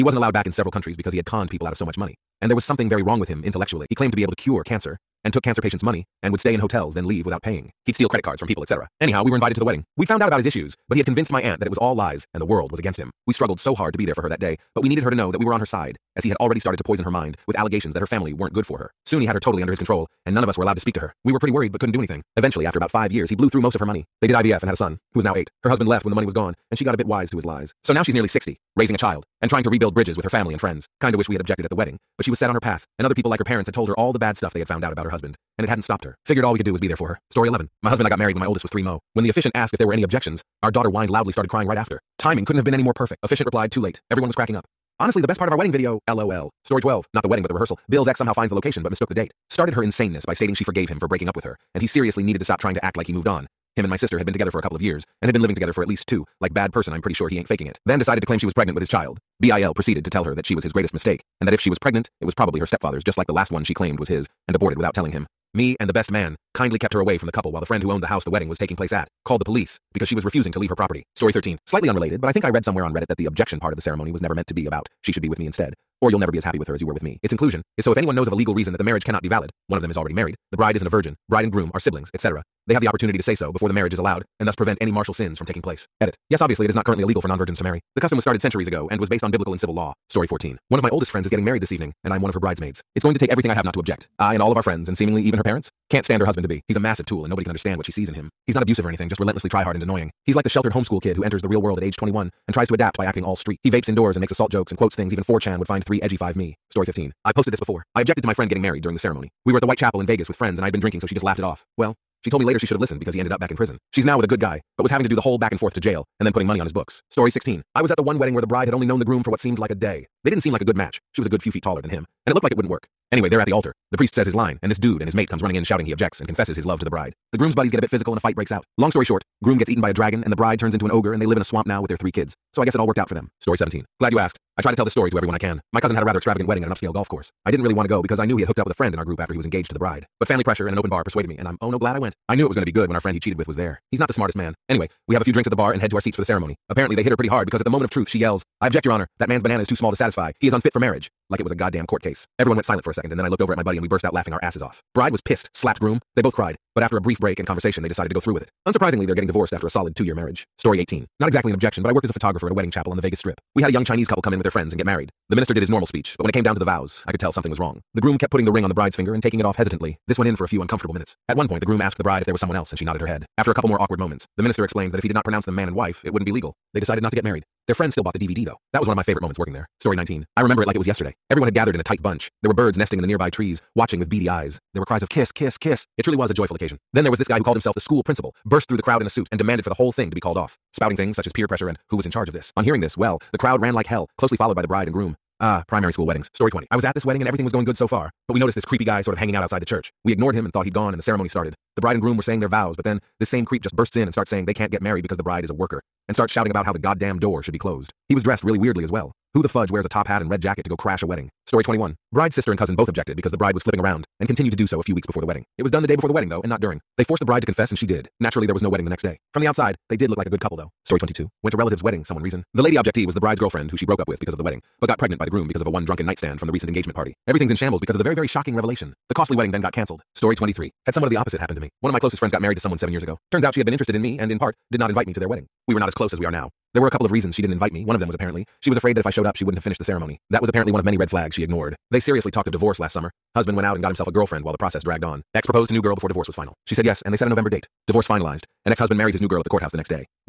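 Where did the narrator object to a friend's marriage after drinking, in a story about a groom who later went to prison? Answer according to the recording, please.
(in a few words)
White Chapel in Vegas.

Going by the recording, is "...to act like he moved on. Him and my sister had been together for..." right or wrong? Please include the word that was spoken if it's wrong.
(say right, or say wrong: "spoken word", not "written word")
right.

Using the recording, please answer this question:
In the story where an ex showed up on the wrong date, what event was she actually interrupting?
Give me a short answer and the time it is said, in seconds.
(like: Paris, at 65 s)
The rehearsal, at 47 s.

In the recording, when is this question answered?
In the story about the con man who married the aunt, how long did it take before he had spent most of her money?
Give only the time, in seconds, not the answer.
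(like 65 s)
22 s.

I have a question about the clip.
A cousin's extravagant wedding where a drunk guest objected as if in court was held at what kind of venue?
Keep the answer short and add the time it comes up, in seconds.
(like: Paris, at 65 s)
An upscale golf course, at 136 s.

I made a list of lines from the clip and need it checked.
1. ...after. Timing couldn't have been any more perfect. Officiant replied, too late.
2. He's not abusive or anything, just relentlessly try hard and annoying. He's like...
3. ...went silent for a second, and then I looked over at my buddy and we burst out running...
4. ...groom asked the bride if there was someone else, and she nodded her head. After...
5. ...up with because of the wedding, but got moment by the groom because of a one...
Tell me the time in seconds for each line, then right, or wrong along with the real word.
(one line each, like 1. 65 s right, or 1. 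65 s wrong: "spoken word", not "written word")
1. 41 s right
2. 98 s right
3. 152 s wrong: "laughing", not "running"
4. 171 s right
5. 223 s wrong: "pregnant", not "moment".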